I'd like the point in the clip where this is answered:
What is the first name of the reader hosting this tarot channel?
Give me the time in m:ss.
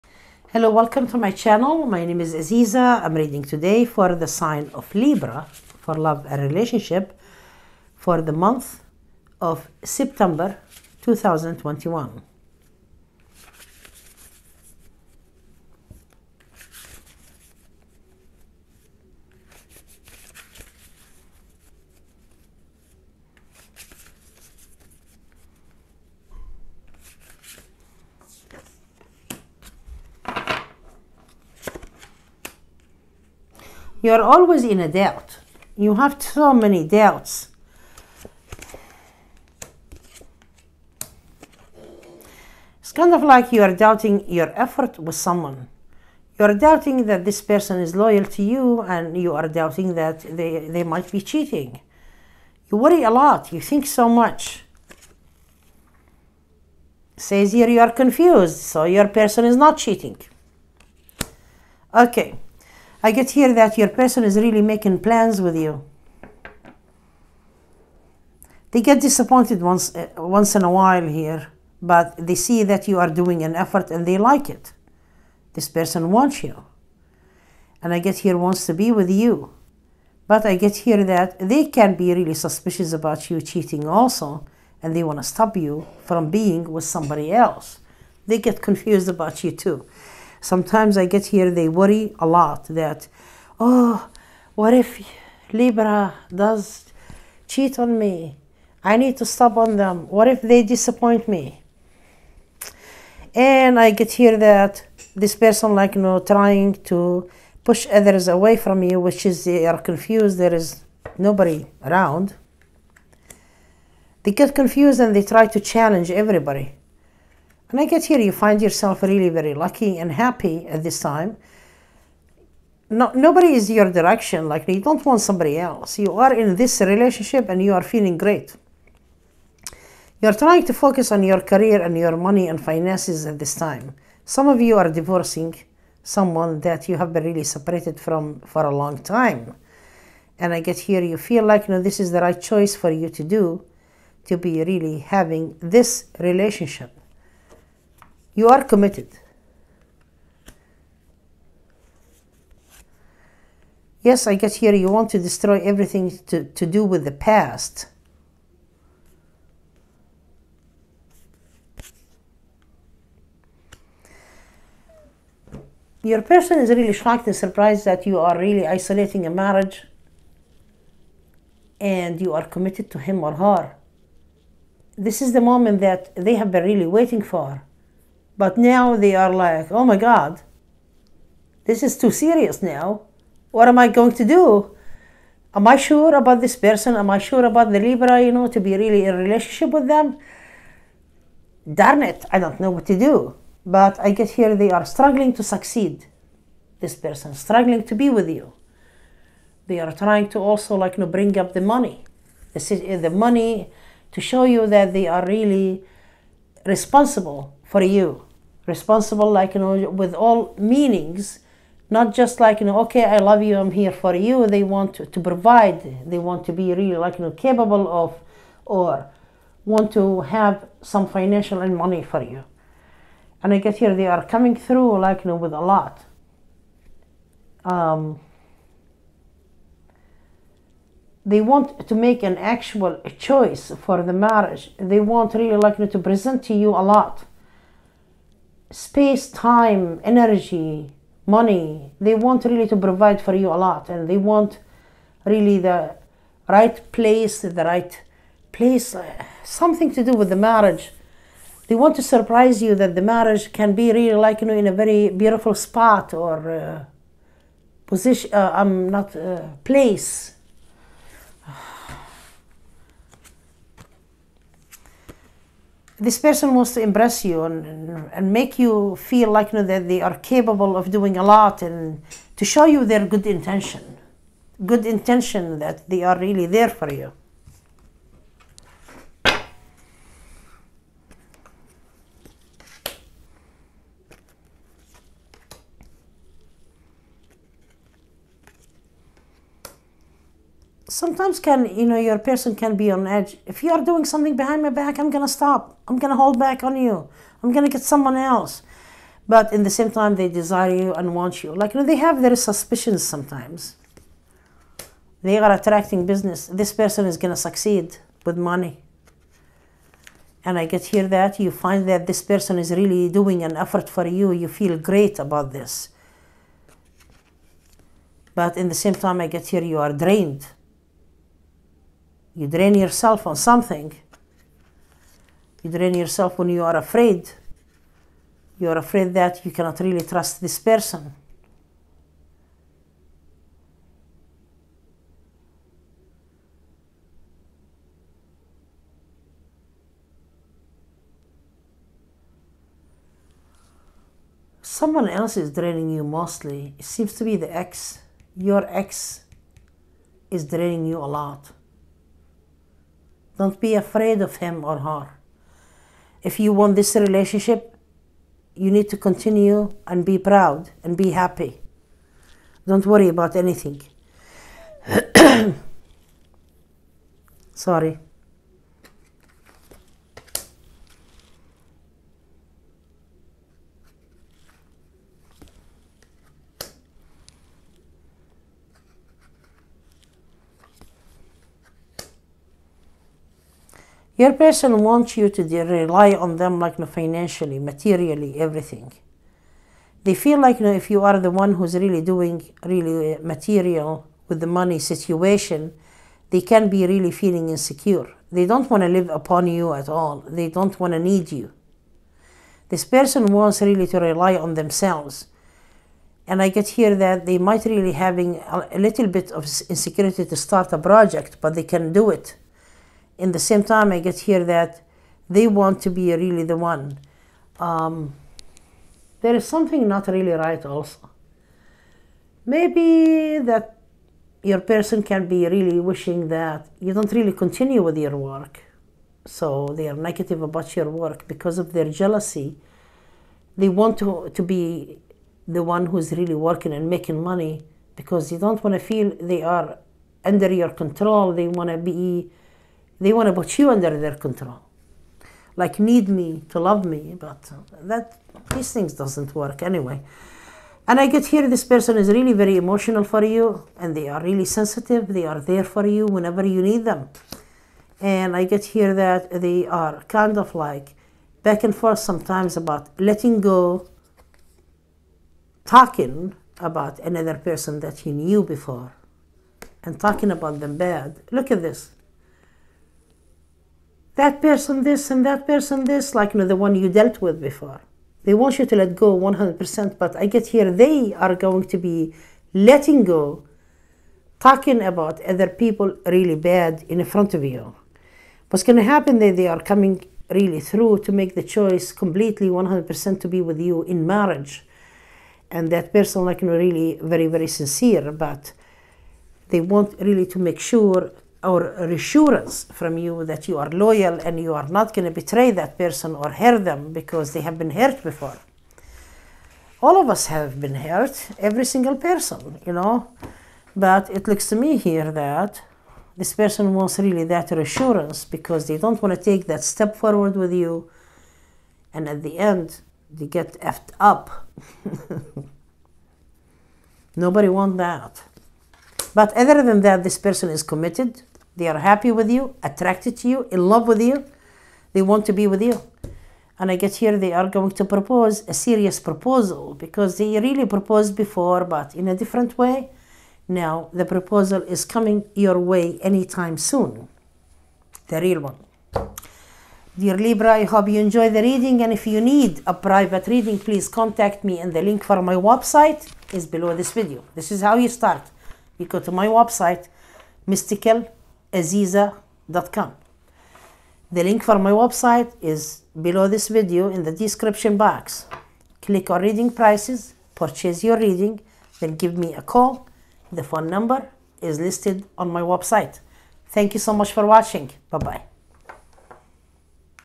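0:02.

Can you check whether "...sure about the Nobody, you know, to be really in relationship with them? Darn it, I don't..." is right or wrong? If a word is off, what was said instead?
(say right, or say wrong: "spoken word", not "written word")
wrong: "Libra", not "Nobody".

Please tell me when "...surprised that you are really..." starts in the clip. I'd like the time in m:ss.
2:47.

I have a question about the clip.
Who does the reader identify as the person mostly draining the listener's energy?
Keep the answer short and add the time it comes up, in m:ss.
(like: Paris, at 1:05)
The ex, at 5:47.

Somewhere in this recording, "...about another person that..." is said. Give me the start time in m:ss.
7:46.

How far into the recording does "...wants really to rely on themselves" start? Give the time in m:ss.
6:43.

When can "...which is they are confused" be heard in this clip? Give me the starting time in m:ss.
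1:48.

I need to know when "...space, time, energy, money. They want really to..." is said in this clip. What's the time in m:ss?
3:58.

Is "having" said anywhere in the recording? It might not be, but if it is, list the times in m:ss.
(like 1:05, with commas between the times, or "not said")
2:24, 6:47.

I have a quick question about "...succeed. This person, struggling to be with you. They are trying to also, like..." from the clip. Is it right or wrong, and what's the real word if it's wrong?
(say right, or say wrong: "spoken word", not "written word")
right.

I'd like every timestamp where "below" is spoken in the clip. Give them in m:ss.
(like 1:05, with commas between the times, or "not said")
9:16, 9:25.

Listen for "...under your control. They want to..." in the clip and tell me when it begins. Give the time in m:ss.
7:20.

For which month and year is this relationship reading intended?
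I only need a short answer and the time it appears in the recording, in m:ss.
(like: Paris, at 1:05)
September 2021, at 0:09.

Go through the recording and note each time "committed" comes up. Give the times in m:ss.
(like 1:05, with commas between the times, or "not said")
2:28, 2:52, 8:50.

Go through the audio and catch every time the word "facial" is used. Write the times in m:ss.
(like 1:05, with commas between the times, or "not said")
not said.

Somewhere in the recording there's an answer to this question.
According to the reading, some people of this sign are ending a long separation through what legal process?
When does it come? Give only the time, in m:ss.
2:14.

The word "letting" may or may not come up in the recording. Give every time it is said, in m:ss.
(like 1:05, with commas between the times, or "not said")
7:43, 8:02.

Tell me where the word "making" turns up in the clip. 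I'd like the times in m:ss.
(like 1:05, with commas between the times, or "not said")
1:04, 7:16.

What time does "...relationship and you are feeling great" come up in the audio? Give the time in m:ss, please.
2:06.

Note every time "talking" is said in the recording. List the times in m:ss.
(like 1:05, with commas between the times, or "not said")
7:45, 7:49, 8:04.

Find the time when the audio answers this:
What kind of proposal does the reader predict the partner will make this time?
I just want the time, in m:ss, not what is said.
8:58.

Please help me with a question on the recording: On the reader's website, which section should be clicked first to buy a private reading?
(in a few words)
Reading prices.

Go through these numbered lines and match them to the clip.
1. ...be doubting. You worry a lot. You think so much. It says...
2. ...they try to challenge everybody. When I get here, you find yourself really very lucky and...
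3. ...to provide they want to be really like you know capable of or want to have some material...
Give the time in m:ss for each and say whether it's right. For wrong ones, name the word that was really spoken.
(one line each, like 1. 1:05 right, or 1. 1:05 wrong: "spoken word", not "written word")
1. 0:51 wrong: "cheating", not "doubting"
2. 1:55 right
3. 3:35 wrong: "financial", not "material".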